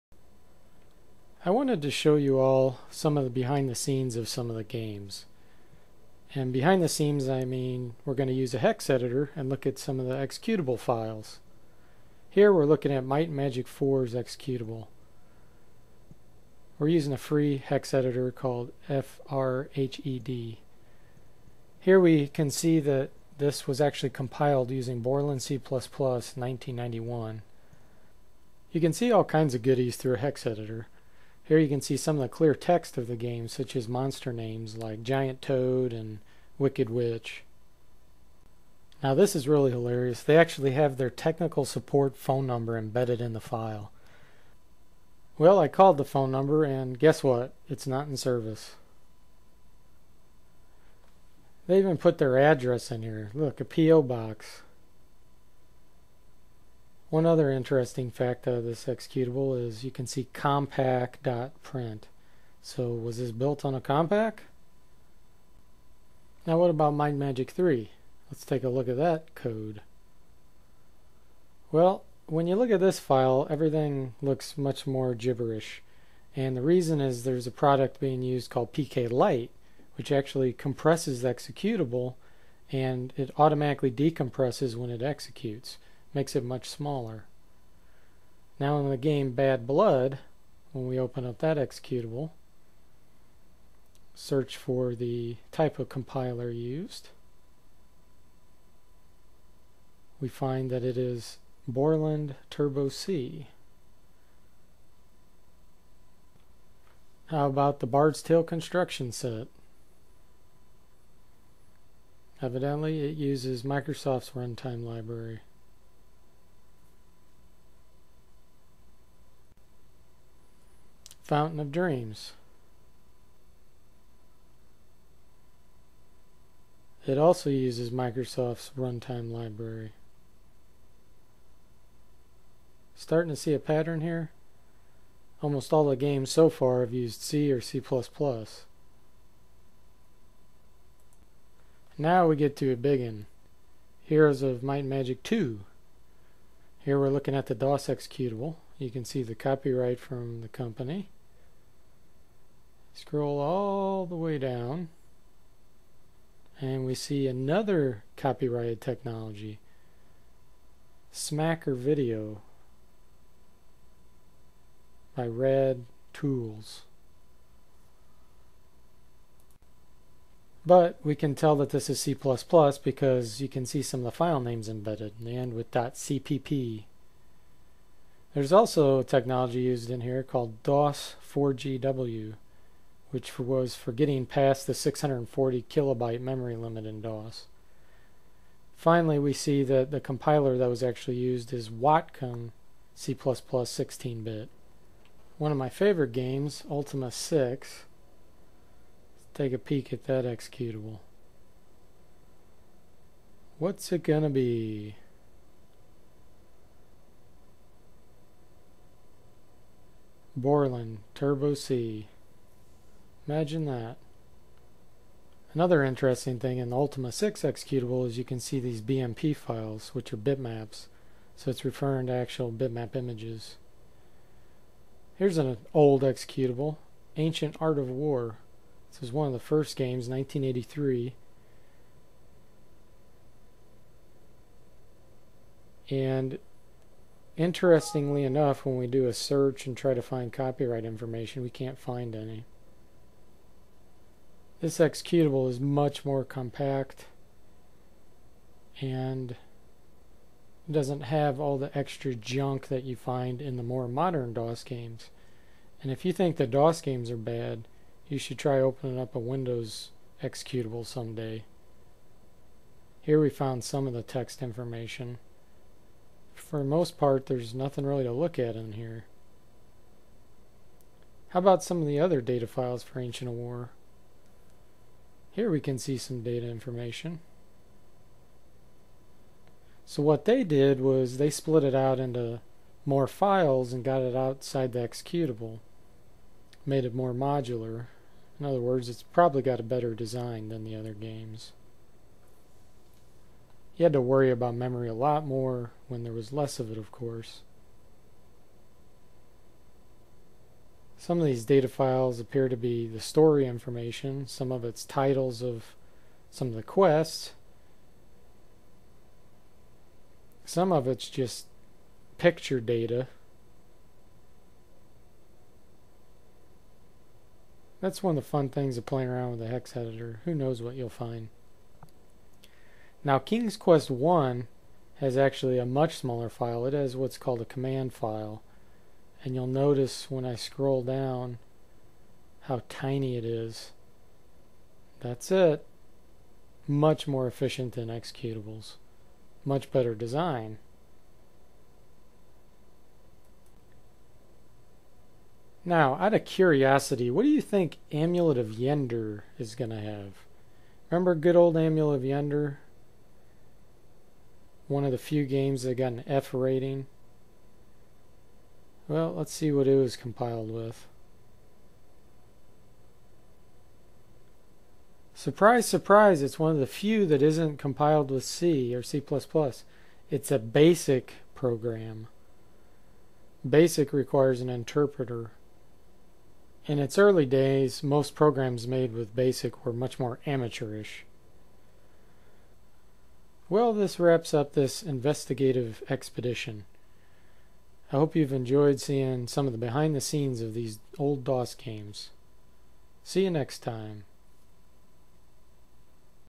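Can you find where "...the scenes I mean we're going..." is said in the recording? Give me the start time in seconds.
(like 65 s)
6 s.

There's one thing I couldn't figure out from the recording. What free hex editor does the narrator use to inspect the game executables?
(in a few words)
FRHED.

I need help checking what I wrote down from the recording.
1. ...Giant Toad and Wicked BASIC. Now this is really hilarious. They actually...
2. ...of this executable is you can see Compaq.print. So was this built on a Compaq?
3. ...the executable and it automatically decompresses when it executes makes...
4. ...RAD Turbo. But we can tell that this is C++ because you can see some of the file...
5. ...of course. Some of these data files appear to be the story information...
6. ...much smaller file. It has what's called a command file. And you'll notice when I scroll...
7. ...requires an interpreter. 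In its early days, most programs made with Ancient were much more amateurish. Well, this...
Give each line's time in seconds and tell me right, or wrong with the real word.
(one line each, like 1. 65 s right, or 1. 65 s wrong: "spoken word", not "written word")
1. 35 s wrong: "Witch", not "BASIC"
2. 58 s right
3. 81 s right
4. 165 s wrong: "Tools", not "Turbo"
5. 296 s right
6. 325 s right
7. 373 s wrong: "BASIC", not "Ancient".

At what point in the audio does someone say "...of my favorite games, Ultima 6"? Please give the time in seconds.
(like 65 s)
195 s.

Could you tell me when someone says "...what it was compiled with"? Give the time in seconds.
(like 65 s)
359 s.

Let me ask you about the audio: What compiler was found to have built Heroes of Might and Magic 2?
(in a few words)
Watcom C++ 16-bit.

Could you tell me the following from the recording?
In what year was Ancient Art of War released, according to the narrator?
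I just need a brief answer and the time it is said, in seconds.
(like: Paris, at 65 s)
1983, at 230 s.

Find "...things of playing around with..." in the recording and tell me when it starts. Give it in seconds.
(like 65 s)
318 s.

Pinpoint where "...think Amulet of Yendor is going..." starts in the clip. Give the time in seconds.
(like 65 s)
347 s.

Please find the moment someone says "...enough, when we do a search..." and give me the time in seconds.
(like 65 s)
238 s.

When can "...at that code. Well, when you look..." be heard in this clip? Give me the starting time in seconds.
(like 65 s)
68 s.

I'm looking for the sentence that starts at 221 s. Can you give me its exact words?
So it's referring to actual bitmap images.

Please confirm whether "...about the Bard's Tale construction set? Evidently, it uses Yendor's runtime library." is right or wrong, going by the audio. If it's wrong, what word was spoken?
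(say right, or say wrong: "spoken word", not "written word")
wrong: "Microsoft", not "Yendor".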